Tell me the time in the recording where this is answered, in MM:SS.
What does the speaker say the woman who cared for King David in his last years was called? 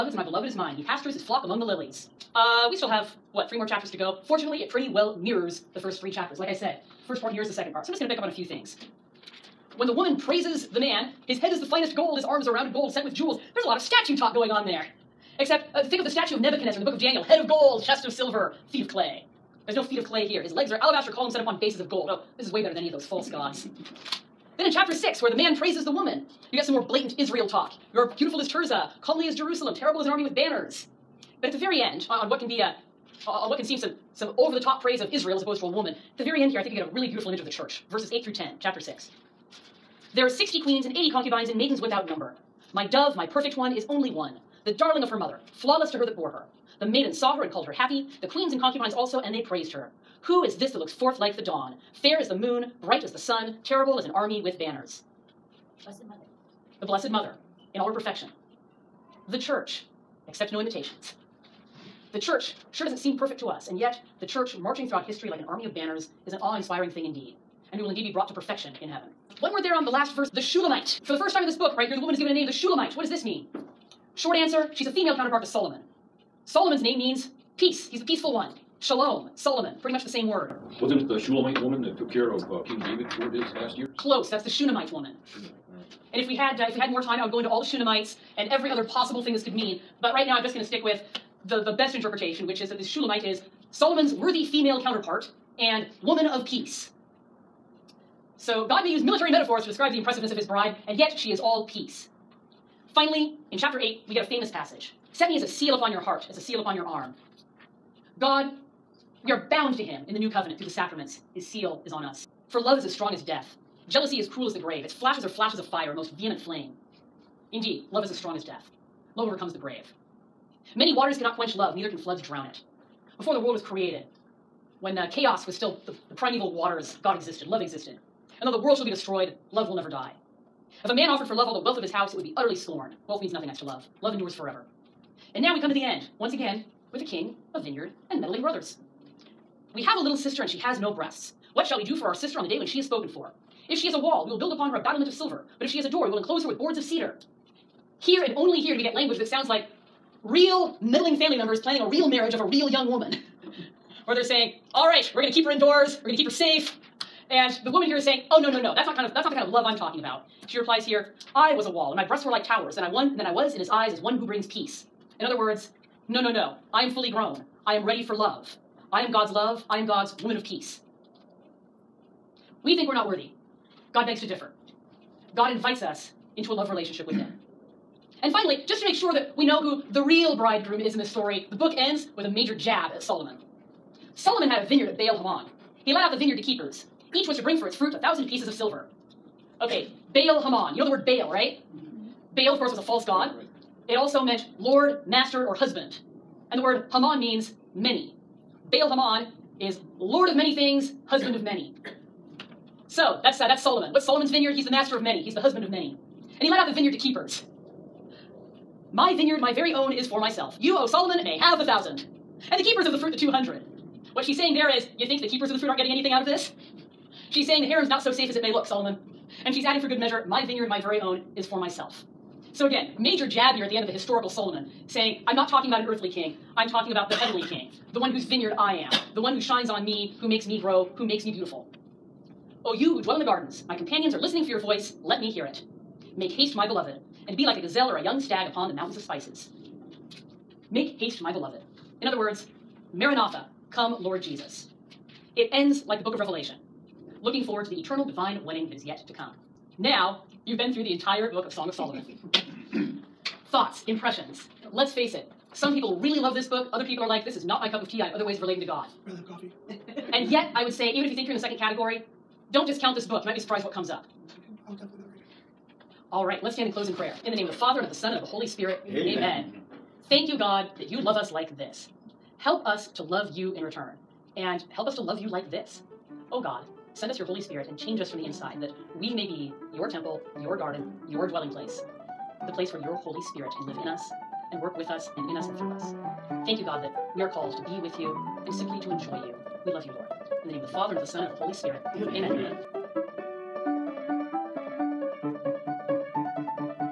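01:24.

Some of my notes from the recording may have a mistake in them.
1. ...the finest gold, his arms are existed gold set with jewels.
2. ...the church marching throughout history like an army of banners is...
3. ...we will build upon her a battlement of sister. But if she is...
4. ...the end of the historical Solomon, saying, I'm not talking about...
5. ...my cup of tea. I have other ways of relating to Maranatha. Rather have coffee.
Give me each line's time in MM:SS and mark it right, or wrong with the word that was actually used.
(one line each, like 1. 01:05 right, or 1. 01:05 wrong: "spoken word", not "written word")
1. 00:11 wrong: "rounded", not "existed"
2. 01:04 right
3. 02:24 wrong: "silver", not "sister"
4. 03:43 right
5. 04:17 wrong: "God", not "Maranatha".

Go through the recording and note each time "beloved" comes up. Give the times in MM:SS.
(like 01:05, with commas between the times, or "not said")
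00:00, 03:56, 04:01.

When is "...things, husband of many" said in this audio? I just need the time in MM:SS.
03:20.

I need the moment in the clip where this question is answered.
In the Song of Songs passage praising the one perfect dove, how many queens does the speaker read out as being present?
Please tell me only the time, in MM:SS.
00:40.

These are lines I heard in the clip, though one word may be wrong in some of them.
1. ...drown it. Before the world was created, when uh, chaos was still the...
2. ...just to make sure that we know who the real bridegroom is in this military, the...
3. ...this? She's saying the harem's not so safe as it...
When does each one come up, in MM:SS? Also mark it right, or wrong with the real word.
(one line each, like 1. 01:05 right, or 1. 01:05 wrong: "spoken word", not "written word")
1. 02:02 right
2. 02:58 wrong: "story", not "military"
3. 03:36 right.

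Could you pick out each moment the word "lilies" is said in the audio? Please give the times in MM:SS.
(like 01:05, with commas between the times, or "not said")
00:01.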